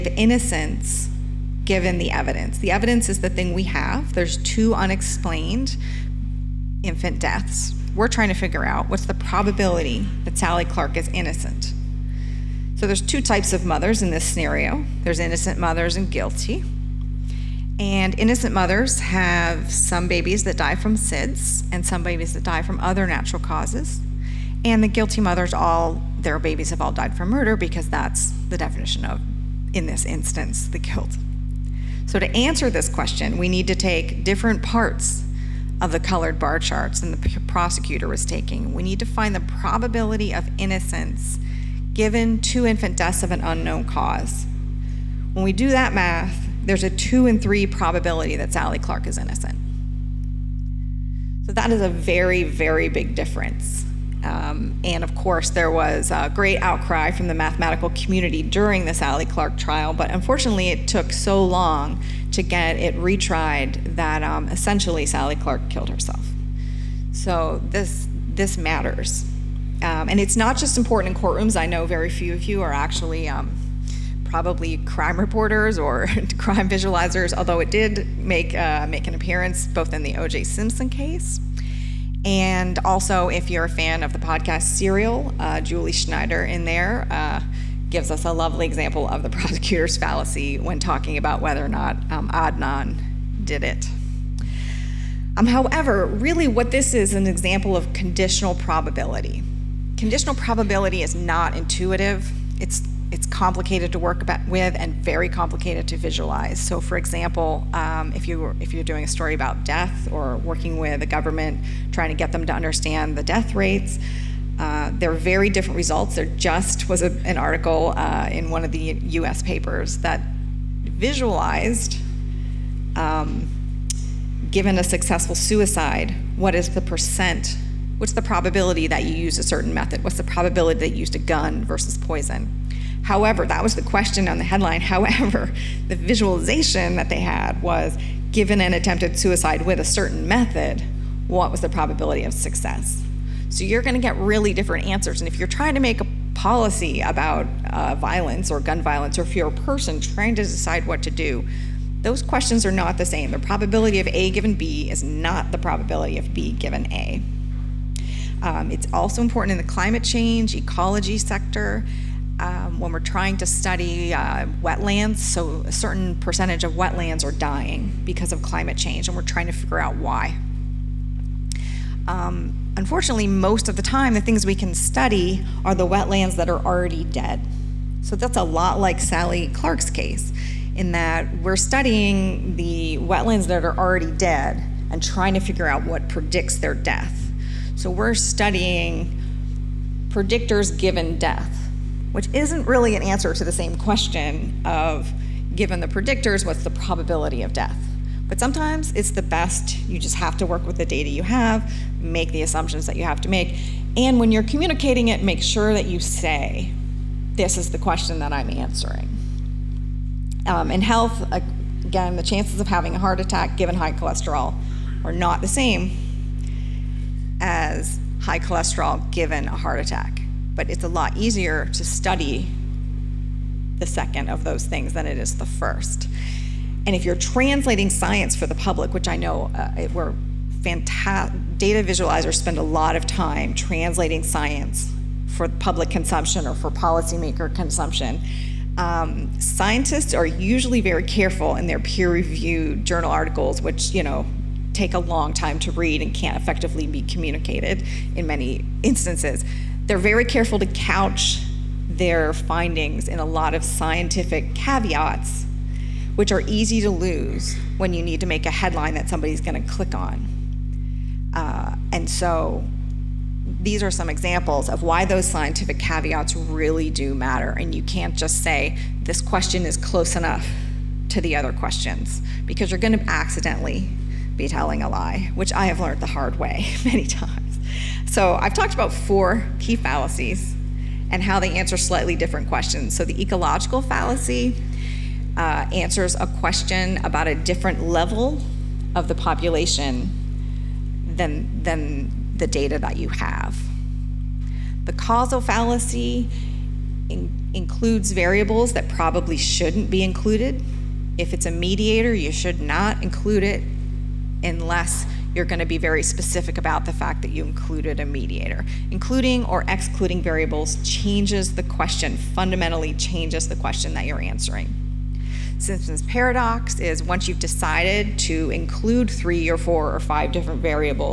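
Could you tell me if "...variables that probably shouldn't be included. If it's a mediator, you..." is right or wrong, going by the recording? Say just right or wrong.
right.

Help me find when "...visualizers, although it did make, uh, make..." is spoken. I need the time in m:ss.
1:16.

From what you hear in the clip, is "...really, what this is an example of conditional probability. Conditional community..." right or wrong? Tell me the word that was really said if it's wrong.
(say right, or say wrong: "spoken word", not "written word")
wrong: "probability", not "community".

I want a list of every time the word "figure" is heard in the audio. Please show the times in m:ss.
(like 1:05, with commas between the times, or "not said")
0:08, 2:49, 3:05.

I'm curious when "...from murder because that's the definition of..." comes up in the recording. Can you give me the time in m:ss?
0:27.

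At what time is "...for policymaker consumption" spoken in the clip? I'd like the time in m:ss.
3:56.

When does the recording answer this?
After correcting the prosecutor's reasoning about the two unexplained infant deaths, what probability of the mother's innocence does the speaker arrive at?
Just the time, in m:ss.
0:46.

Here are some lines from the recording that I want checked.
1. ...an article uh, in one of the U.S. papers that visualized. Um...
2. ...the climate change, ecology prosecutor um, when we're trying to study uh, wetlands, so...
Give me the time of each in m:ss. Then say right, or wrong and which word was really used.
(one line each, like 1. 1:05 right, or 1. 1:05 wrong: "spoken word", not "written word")
1. 1:57 right
2. 2:39 wrong: "sector", not "prosecutor".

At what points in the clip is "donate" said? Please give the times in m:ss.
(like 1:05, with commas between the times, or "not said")
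not said.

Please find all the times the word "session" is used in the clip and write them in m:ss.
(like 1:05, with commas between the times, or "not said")
not said.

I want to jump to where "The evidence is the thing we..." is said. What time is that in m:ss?
0:02.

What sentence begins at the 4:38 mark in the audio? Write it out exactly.
So I've talked about four key fallacies and how they answer slightly different questions.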